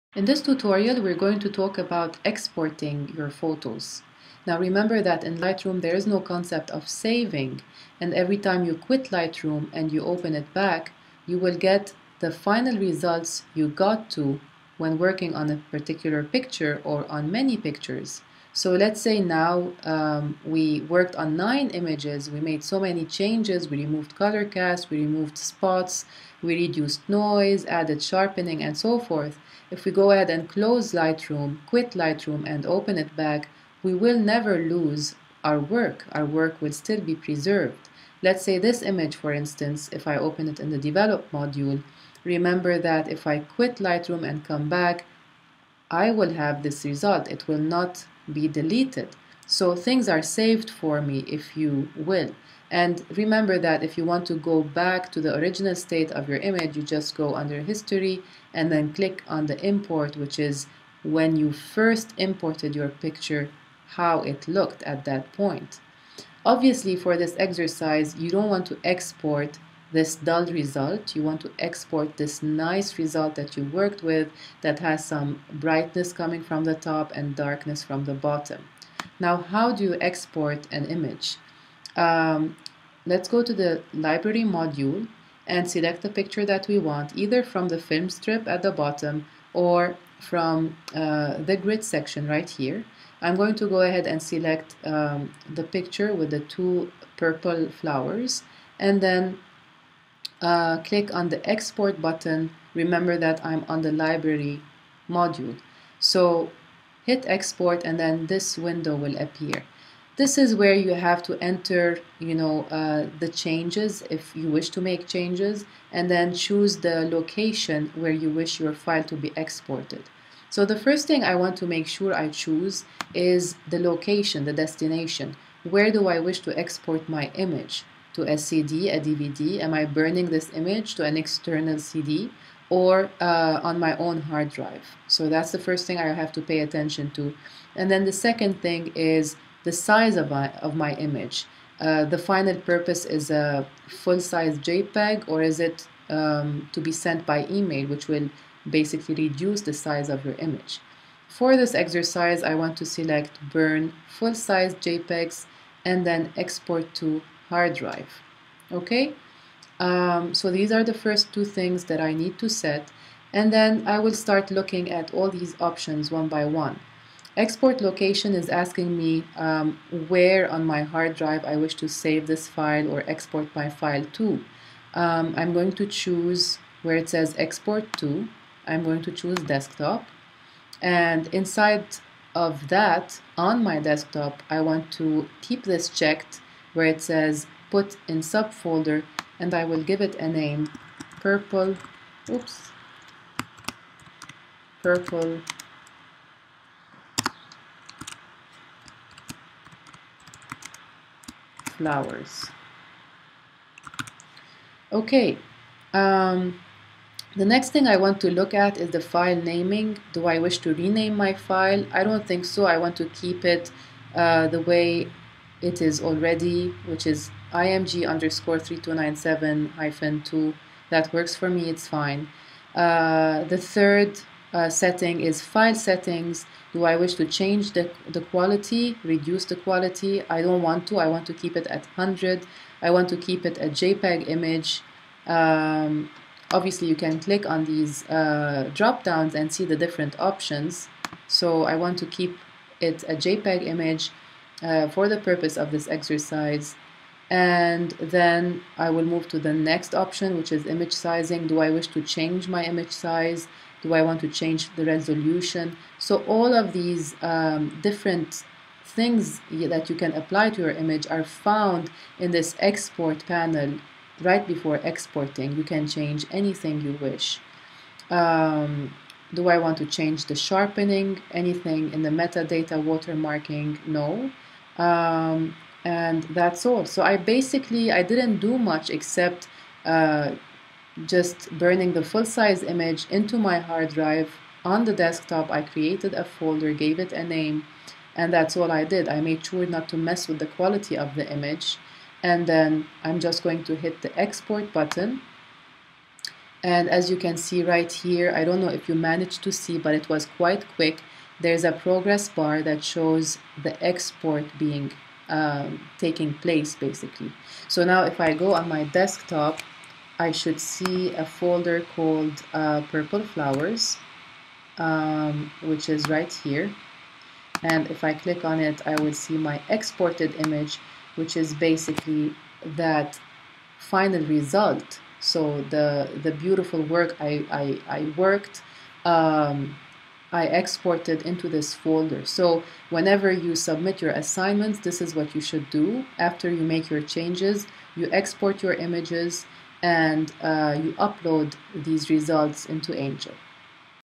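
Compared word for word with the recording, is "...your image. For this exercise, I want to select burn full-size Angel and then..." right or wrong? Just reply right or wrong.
wrong.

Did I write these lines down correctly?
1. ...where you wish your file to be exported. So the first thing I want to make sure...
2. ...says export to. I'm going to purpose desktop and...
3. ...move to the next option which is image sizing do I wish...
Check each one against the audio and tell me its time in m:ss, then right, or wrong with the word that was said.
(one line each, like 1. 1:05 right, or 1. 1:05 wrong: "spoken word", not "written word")
1. 1:57 right
2. 2:57 wrong: "choose", not "purpose"
3. 4:09 right.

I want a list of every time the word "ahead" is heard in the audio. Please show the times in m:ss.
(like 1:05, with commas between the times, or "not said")
0:30, 1:33.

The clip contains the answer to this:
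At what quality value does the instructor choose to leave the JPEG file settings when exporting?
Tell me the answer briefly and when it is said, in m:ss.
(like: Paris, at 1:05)
100, at 3:51.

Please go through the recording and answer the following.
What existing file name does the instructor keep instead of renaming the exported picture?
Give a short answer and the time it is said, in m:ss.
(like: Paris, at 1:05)
img_3297-2, at 3:37.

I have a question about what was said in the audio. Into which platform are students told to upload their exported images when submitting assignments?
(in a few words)
Angel.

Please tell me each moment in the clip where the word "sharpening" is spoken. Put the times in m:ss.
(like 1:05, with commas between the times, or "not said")
0:28, 4:30.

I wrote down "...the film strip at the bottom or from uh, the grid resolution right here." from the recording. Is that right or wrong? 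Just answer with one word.
wrong.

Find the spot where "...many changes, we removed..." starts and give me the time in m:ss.
0:22.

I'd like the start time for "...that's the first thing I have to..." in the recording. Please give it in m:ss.
2:15.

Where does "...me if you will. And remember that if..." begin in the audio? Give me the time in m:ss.
0:51.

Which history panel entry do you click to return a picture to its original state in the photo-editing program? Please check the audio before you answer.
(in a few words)
Import.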